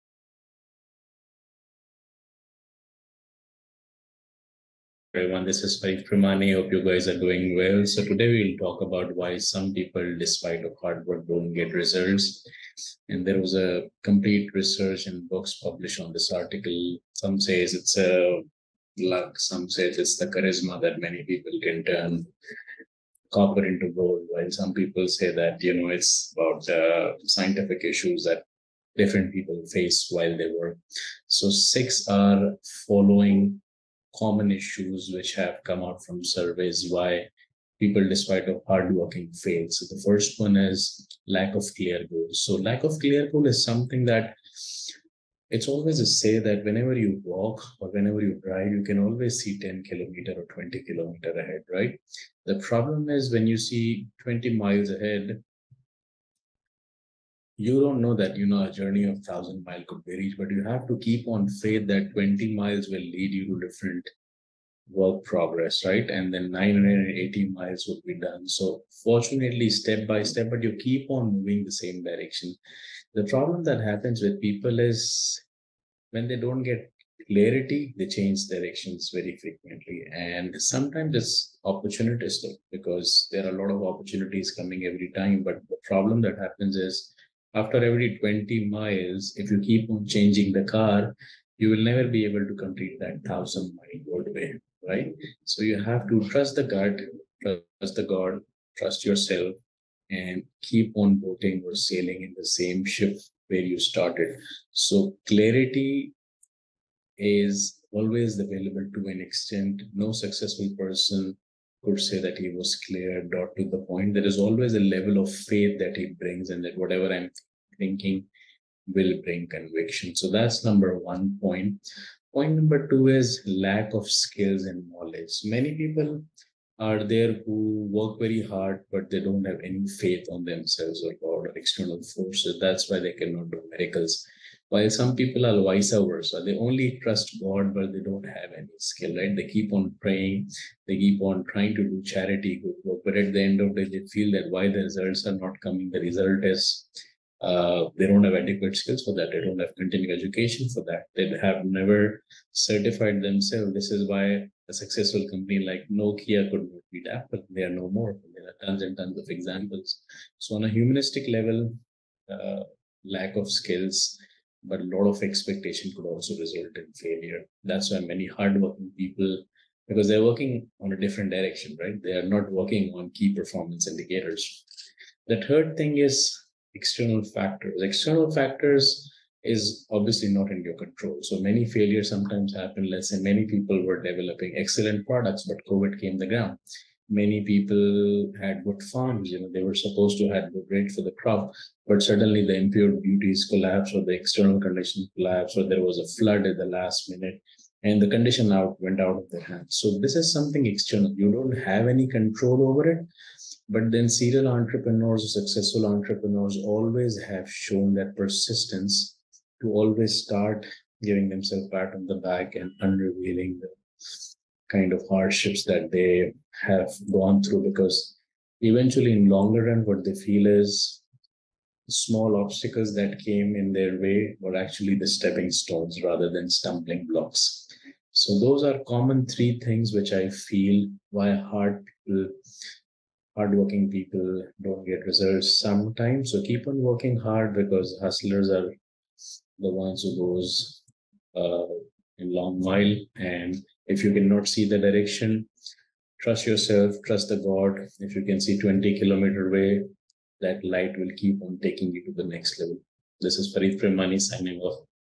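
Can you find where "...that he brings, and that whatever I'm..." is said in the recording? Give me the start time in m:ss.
1:55.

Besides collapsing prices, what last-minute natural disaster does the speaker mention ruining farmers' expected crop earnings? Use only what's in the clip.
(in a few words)
A flood.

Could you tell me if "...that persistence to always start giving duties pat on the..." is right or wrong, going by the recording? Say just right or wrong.
wrong.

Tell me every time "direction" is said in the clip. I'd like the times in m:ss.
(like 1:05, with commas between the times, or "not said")
1:12, 1:18, 2:51, 4:04.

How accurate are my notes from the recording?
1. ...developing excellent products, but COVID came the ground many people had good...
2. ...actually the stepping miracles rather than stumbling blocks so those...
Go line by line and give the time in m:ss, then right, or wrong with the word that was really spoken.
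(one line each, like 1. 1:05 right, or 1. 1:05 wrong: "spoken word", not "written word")
1. 3:04 right
2. 3:44 wrong: "stones", not "miracles".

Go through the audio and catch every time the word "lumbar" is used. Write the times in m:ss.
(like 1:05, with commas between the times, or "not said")
not said.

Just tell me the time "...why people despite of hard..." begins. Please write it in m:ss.
0:36.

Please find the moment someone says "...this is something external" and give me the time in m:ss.
3:19.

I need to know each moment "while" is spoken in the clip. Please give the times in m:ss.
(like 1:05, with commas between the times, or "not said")
0:24, 0:30, 2:14, 4:02.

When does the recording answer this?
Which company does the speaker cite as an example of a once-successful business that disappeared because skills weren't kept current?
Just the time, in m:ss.
2:35.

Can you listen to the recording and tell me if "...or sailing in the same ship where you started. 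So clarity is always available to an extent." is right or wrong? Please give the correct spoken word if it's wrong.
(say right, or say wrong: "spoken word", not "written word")
right.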